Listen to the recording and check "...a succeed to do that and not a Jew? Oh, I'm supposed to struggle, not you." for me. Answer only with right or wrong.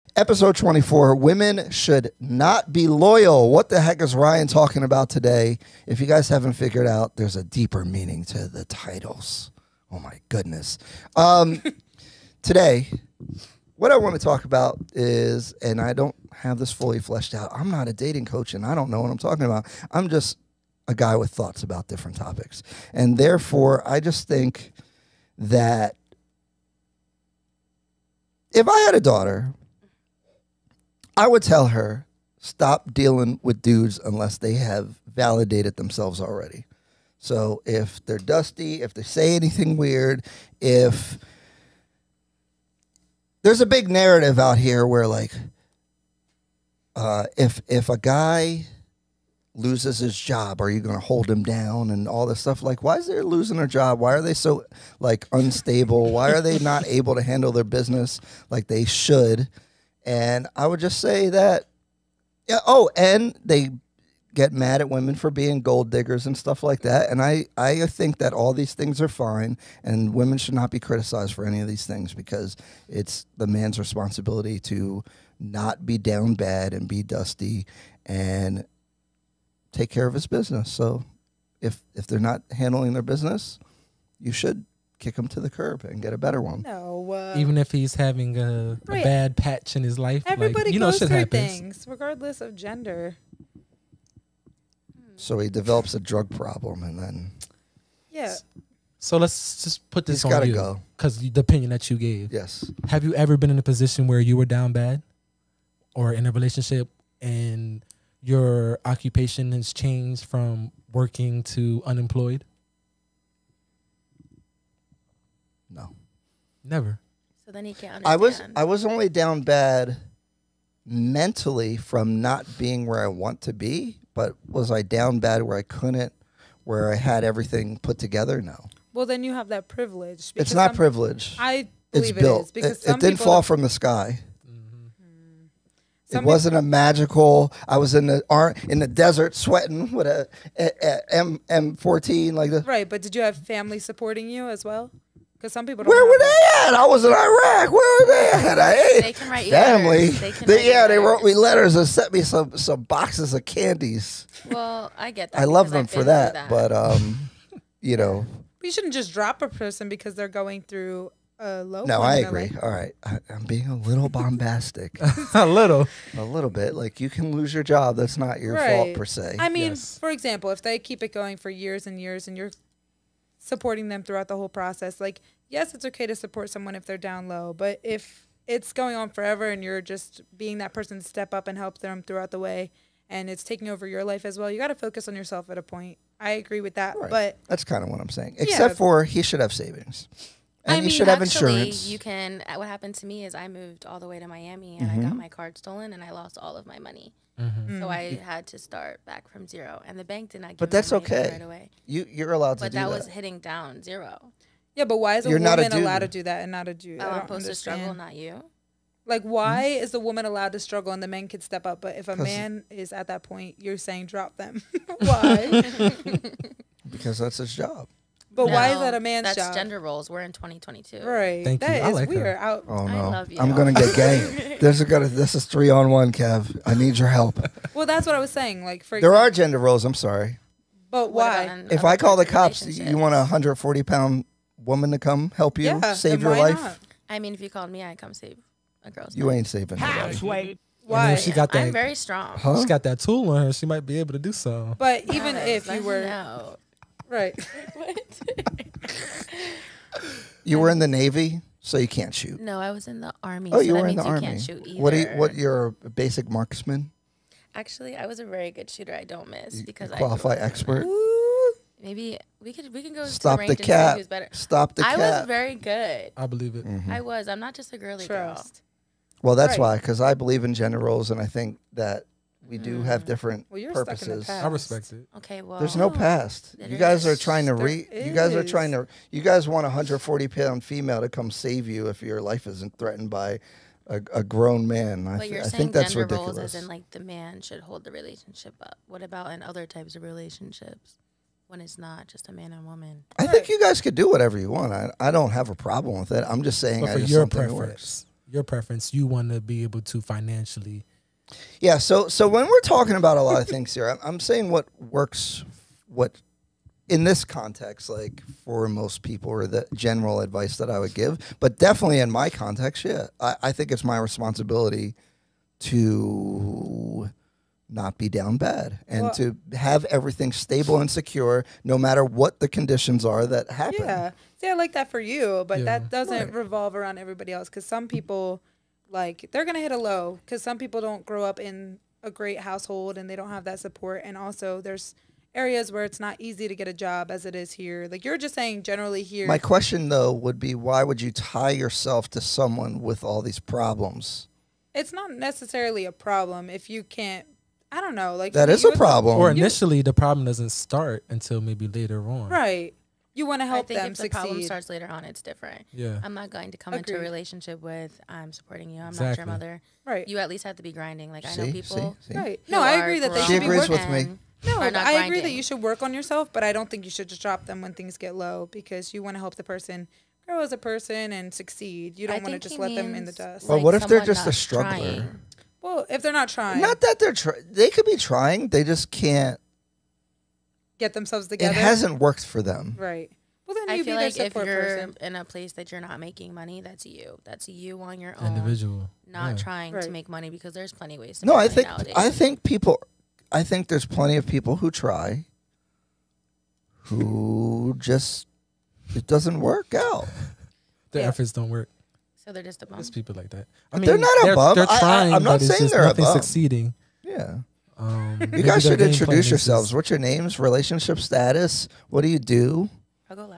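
wrong.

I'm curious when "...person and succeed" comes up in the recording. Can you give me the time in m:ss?
6:10.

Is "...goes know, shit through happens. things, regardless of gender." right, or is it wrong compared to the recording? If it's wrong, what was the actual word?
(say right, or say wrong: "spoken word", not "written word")
right.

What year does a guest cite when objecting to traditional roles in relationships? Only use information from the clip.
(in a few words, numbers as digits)
2022.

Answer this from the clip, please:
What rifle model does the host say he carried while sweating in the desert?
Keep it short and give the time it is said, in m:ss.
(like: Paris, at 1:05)
M14, at 2:21.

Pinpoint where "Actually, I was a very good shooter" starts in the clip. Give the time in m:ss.
4:17.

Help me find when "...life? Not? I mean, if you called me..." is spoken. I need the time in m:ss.
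3:56.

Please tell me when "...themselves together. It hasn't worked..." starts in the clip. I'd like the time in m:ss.
6:20.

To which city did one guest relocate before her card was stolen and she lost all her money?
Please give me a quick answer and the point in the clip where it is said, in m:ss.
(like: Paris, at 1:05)
Miami, at 3:14.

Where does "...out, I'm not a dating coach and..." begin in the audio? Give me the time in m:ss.
0:17.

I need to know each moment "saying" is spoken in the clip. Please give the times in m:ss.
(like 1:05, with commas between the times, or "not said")
3:08, 3:33, 3:48, 4:56, 5:04, 5:38, 6:45.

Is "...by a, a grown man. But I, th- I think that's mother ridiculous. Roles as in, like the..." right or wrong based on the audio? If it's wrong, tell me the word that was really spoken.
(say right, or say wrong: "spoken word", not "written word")
wrong: "gender", not "mother".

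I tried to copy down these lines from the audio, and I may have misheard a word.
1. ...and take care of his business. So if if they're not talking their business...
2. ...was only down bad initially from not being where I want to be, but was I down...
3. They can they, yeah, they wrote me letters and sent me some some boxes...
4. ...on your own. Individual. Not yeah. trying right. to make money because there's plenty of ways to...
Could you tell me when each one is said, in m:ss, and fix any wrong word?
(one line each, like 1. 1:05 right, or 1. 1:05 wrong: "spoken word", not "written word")
1. 1:18 wrong: "handling", not "talking"
2. 1:58 wrong: "mentally", not "initially"
3. 2:30 right
4. 6:27 right.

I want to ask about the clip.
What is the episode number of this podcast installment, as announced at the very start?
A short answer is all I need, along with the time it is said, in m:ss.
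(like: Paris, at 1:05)
24, at 0:00.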